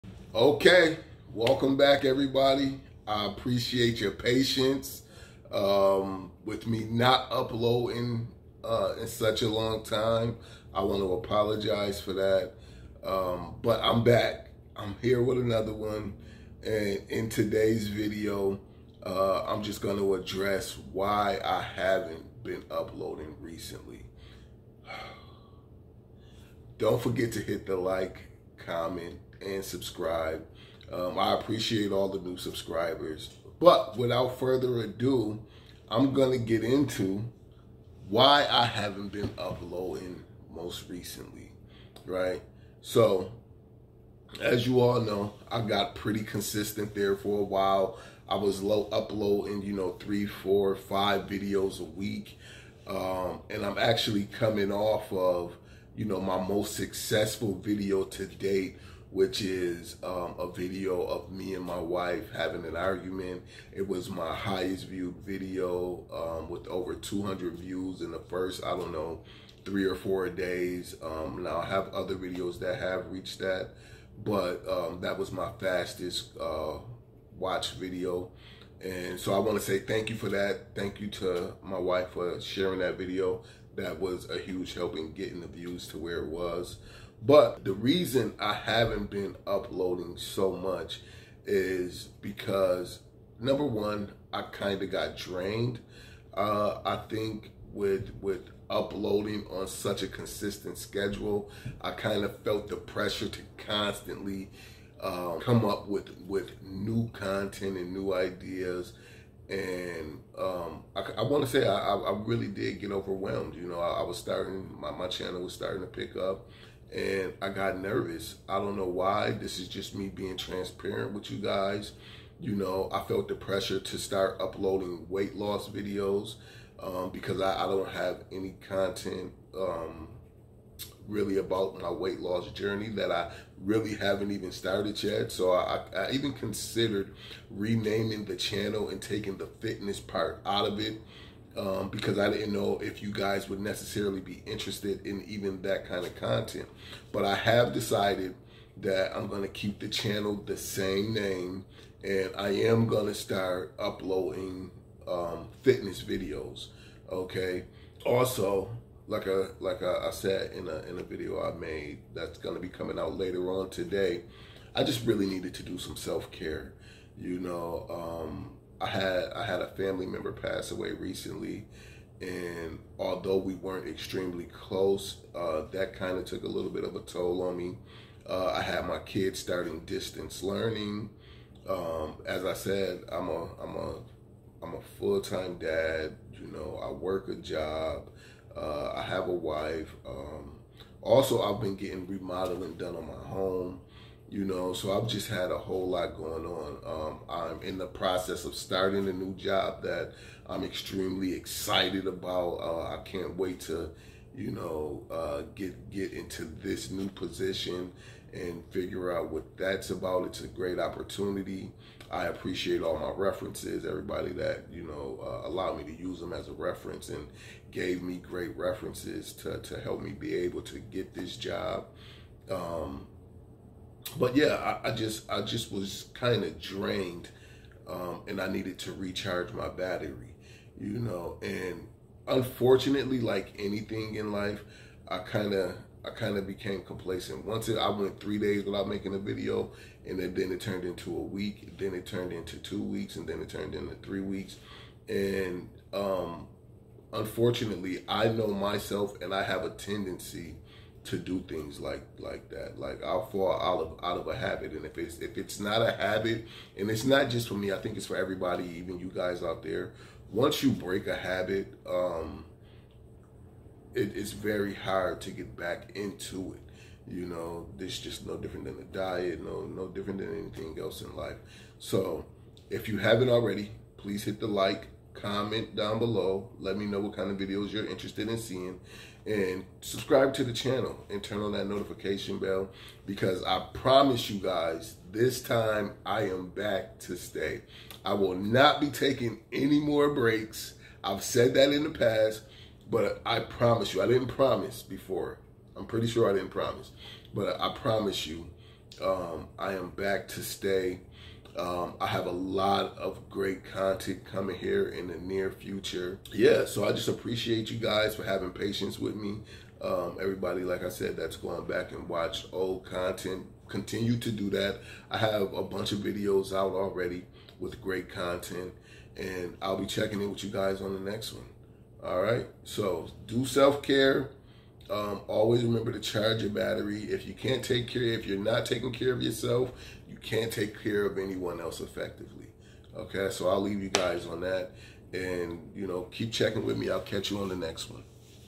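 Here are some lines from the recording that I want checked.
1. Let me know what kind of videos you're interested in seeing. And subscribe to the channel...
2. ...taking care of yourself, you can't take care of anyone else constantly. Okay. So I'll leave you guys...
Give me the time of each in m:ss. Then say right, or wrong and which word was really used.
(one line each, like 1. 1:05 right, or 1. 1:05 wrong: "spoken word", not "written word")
1. 4:36 right
2. 5:28 wrong: "effectively", not "constantly".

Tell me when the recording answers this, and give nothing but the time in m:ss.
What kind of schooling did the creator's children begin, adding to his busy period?
2:59.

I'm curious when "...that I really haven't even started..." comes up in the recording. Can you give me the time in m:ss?
2:12.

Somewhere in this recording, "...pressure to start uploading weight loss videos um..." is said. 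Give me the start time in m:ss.
2:03.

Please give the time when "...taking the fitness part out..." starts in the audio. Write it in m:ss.
2:19.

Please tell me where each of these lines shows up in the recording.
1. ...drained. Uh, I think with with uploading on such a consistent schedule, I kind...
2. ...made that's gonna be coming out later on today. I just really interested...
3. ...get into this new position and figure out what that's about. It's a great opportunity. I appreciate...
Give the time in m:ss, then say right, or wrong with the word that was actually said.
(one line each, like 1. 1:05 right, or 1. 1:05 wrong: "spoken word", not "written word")
1. 1:35 right
2. 2:41 wrong: "needed", not "interested"
3. 3:25 right.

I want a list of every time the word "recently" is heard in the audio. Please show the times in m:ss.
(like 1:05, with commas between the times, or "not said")
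0:23, 0:40, 2:50.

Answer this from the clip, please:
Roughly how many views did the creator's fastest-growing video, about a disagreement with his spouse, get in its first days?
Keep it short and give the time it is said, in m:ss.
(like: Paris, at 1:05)
over 200, at 1:06.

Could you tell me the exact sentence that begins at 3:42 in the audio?
Um, but yeah, I, I just I just was kind of drained, um, and I needed to recharge my battery, you know.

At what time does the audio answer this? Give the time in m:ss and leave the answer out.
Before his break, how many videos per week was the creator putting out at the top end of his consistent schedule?
0:50.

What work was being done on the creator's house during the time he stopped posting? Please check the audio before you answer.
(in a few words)
remodeling.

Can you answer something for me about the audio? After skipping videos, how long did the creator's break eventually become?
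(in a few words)
3 weeks.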